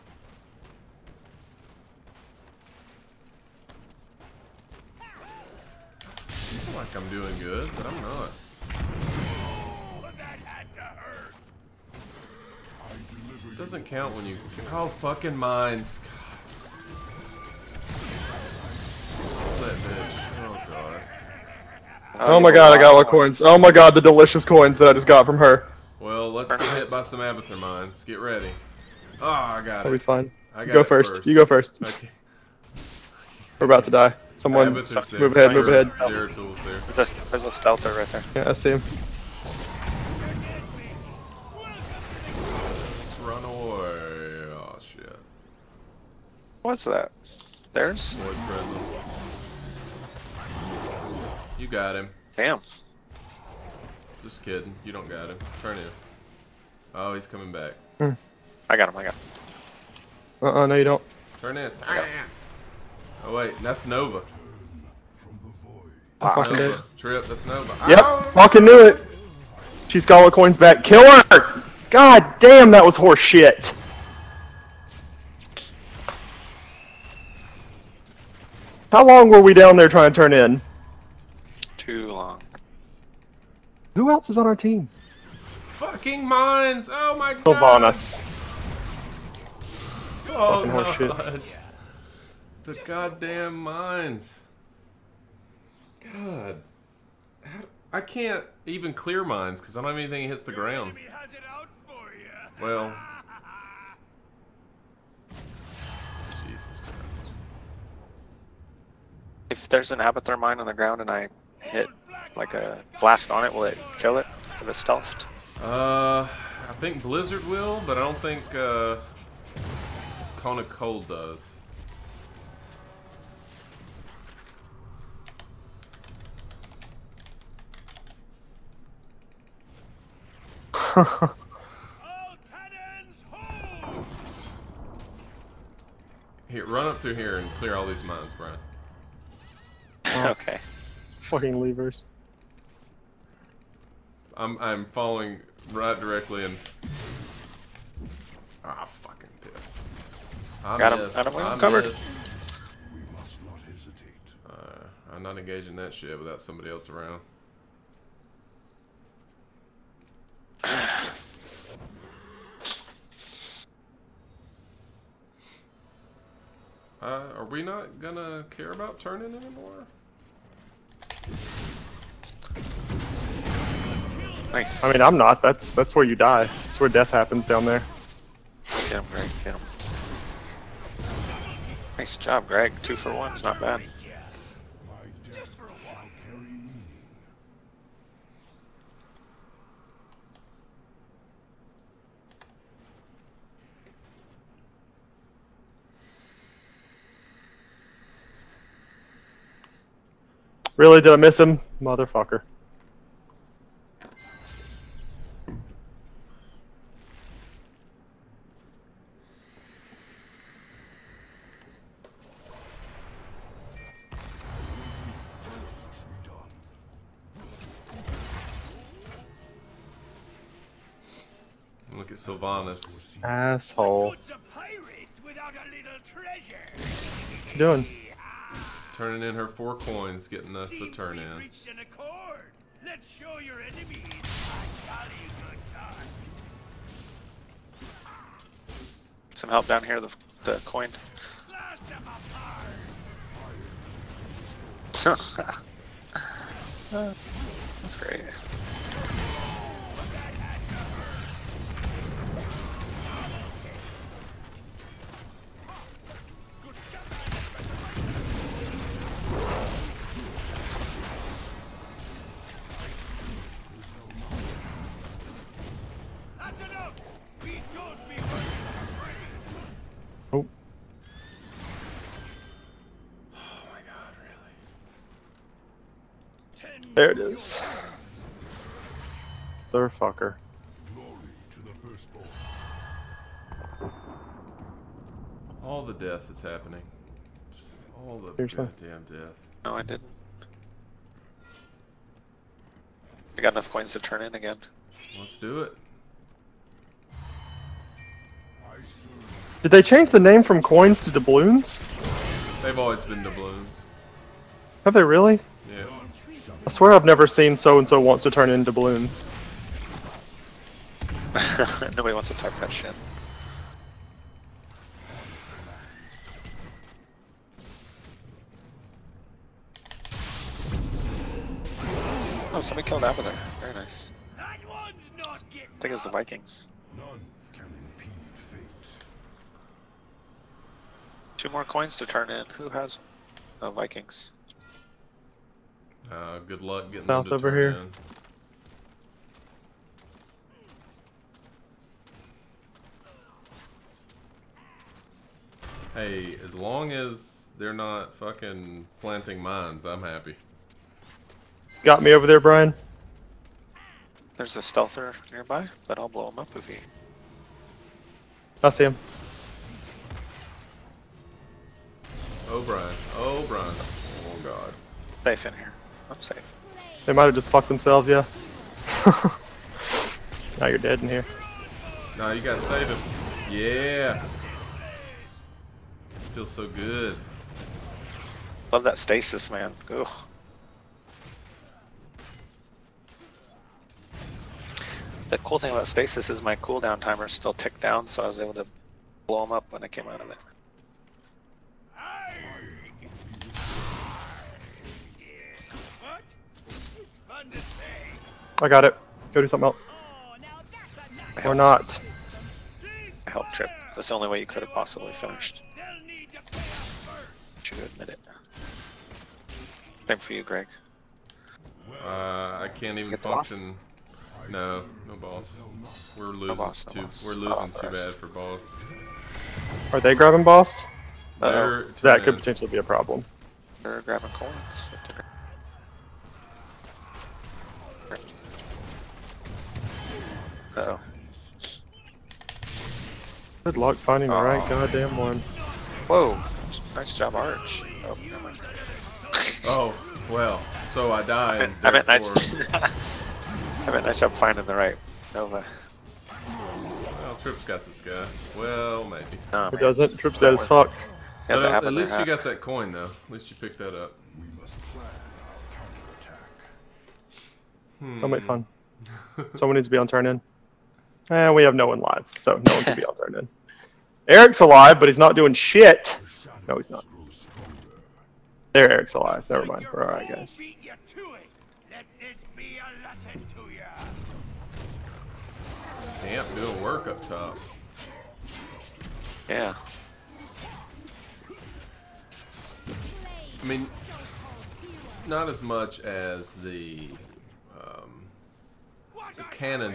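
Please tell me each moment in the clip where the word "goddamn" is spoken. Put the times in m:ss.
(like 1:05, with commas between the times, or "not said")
1:32, 4:48, 7:14.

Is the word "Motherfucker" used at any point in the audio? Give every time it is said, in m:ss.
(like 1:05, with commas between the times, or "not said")
3:21.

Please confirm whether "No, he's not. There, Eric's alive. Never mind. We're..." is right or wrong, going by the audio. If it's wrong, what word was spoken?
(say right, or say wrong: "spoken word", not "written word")
right.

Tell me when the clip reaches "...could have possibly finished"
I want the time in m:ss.
6:44.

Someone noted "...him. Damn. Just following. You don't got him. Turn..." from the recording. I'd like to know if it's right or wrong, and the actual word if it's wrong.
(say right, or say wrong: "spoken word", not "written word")
wrong: "kidding", not "following".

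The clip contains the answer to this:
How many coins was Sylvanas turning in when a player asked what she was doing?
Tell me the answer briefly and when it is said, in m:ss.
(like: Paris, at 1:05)
4, at 3:49.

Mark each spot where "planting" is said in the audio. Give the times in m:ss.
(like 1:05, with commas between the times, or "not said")
5:48.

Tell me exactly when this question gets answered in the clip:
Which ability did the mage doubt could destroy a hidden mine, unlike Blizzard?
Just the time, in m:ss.
2:00.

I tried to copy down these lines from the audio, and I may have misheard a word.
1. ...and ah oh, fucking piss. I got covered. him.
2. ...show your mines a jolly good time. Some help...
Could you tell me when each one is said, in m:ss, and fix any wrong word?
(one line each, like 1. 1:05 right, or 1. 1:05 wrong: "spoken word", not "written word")
1. 2:26 wrong: "missed", not "covered"
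2. 3:53 wrong: "enemies", not "mines".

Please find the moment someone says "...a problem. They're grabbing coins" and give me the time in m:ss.
7:02.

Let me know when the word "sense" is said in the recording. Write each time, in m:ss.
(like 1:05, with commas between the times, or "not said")
not said.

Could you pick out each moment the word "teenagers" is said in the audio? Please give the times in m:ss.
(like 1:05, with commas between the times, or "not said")
not said.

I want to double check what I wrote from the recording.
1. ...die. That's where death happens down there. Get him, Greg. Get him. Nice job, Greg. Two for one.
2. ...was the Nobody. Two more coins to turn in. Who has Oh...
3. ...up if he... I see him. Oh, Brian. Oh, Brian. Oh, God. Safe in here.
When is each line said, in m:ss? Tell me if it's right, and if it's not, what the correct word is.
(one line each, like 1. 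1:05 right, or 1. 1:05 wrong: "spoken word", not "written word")
1. 2:56 right
2. 5:25 wrong: "Vikings", not "Nobody"
3. 5:56 right.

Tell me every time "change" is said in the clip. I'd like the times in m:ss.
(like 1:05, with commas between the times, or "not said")
4:59.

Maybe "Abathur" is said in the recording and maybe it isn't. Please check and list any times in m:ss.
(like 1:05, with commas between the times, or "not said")
0:27, 1:49.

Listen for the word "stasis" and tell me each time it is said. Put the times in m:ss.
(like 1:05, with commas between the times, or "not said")
6:18, 6:25.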